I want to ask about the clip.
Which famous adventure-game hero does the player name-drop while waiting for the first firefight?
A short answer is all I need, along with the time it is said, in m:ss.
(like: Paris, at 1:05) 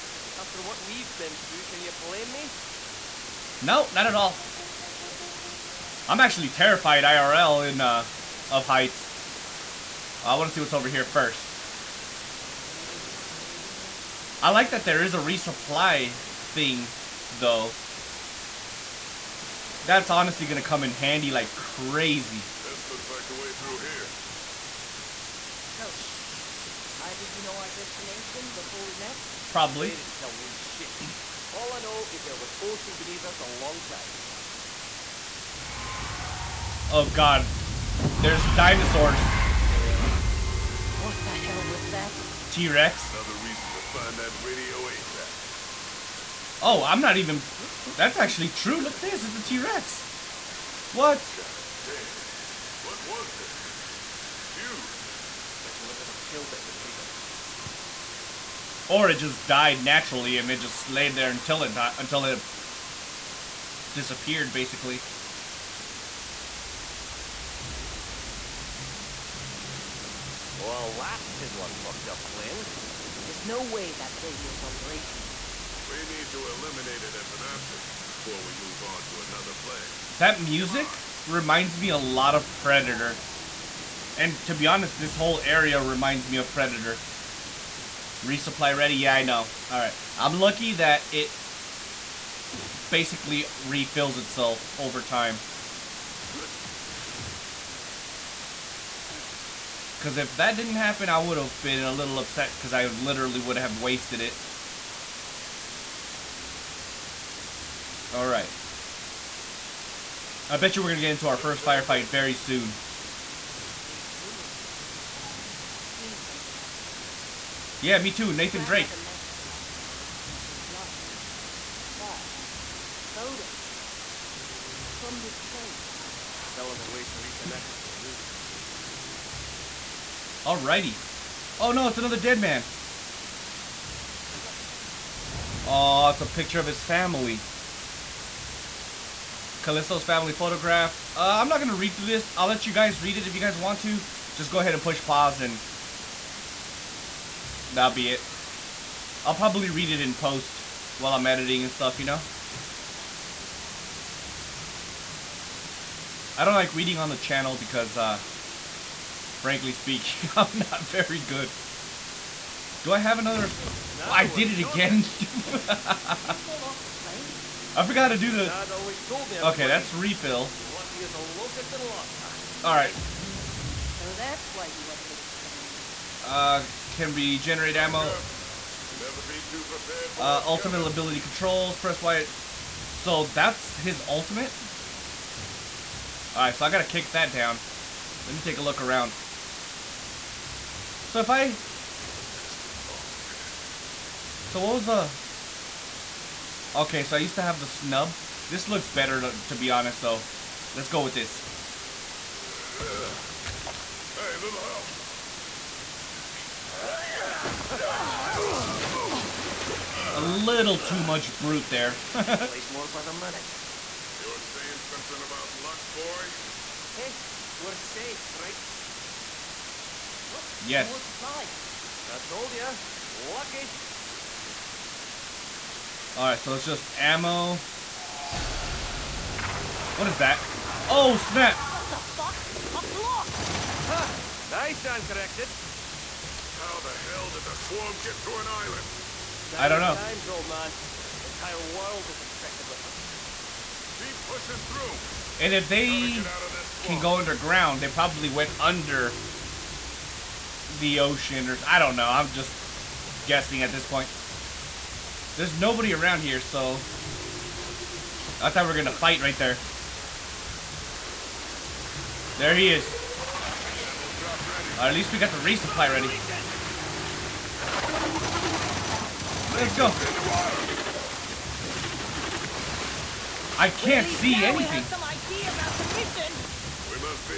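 Nathan Drake, at 1:58.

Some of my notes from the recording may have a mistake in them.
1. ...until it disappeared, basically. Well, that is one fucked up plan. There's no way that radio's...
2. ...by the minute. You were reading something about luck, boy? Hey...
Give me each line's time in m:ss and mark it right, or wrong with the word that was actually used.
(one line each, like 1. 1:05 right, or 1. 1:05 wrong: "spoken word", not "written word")
1. 1:01 right
2. 3:32 wrong: "saying", not "reading".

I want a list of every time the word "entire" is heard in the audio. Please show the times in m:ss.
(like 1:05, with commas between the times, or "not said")
4:01.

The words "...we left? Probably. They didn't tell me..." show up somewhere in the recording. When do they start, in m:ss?
0:28.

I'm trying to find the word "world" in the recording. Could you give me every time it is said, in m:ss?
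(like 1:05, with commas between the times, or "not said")
4:01.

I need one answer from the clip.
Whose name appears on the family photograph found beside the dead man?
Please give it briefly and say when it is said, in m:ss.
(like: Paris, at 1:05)
Kaliso, at 2:19.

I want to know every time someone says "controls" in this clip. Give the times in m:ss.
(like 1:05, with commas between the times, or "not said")
3:01.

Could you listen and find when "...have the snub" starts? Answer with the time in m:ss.
3:17.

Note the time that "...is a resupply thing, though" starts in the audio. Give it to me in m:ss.
0:15.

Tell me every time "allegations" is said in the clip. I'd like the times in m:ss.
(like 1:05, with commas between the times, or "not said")
not said.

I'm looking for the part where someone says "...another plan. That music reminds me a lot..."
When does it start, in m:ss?
1:19.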